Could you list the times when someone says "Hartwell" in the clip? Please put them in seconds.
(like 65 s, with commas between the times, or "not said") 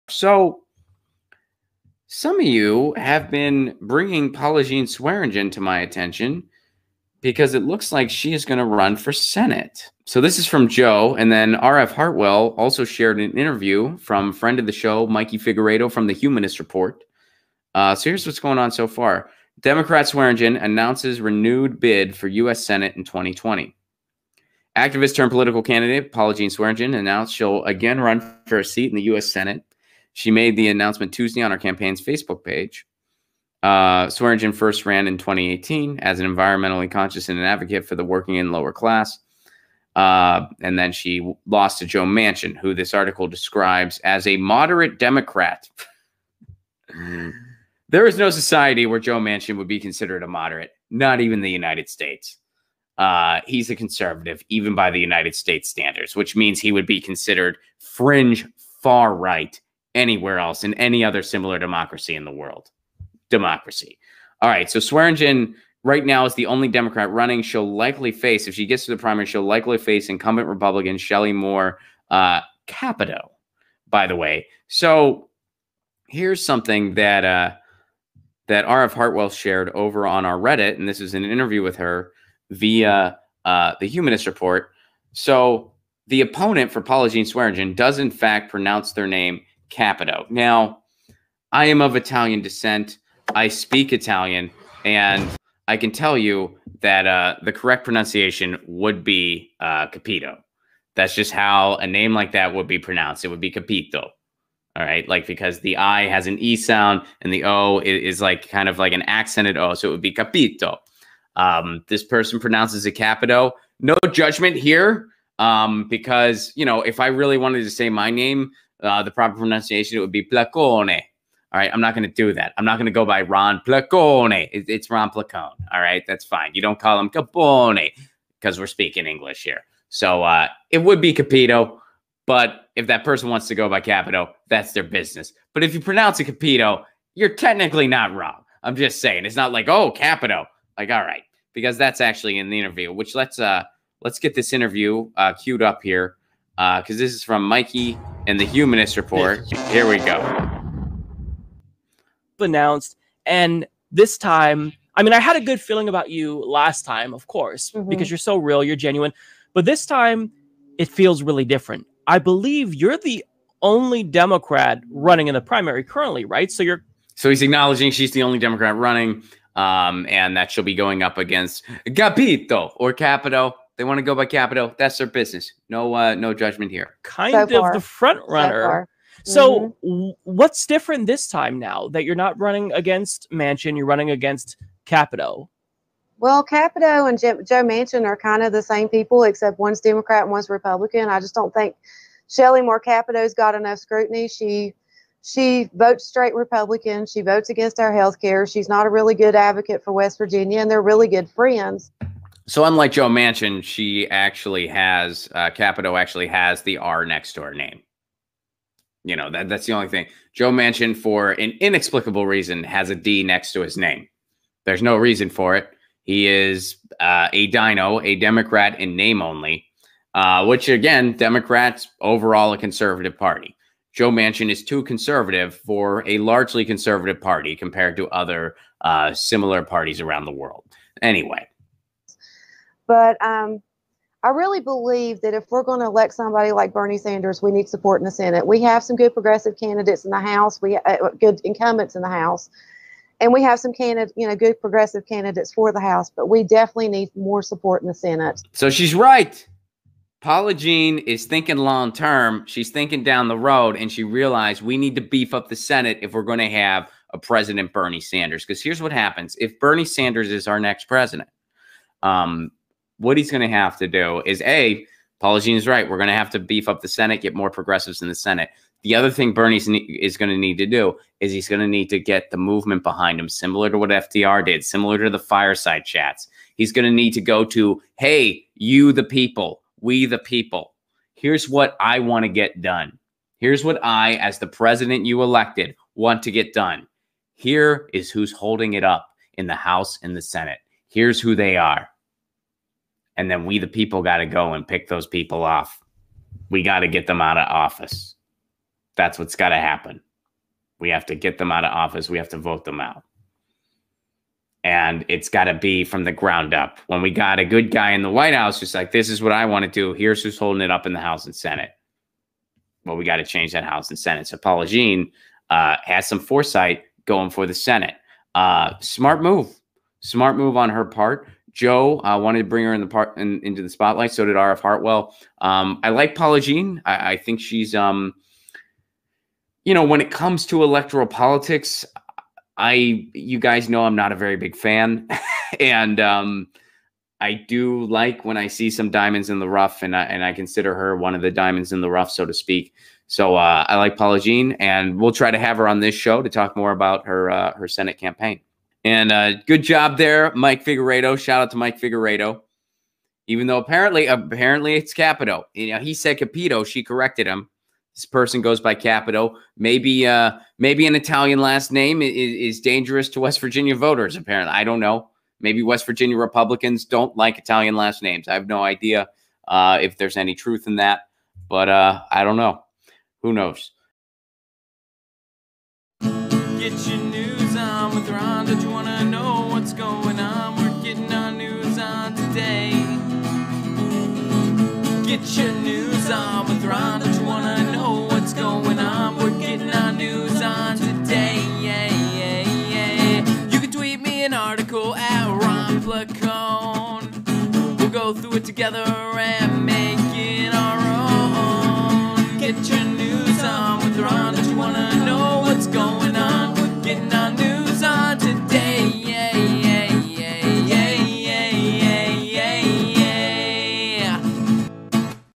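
11 s, 78 s, 324 s.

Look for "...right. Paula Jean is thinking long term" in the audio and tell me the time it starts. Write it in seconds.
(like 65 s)
248 s.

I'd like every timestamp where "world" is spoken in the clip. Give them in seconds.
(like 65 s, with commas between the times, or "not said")
62 s, 230 s.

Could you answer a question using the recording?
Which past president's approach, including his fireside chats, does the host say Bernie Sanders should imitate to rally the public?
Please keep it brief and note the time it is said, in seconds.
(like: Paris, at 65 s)
FDR, at 273 s.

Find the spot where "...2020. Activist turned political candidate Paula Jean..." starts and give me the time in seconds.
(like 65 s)
23 s.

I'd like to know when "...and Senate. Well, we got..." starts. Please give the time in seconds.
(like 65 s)
311 s.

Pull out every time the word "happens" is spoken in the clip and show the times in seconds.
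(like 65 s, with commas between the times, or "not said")
258 s, 299 s.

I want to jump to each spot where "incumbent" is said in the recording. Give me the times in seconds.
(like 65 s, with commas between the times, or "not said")
70 s, 241 s.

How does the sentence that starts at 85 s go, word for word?
So the opponent for Paula Jean Swearengin does in fact pronounce their name capito.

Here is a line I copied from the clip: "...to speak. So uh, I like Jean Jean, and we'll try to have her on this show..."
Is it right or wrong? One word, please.
wrong.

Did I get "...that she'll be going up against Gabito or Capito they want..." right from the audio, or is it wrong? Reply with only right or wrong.
right.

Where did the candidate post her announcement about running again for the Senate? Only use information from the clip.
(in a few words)
Facebook.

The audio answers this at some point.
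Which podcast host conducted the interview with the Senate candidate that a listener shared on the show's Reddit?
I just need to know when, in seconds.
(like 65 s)
15 s.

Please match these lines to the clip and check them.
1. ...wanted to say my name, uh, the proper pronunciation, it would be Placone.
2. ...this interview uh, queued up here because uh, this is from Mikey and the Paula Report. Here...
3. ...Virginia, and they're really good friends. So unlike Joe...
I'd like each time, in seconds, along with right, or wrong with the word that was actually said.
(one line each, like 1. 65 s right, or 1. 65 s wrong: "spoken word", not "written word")
1. 117 s right
2. 144 s wrong: "Humanist", not "Paula"
3. 200 s right.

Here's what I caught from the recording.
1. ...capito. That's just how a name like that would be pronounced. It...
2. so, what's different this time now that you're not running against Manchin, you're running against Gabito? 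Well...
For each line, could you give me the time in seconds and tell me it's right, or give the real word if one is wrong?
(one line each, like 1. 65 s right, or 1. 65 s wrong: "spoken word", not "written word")
1. 99 s right
2. 180 s wrong: "Capito", not "Gabito".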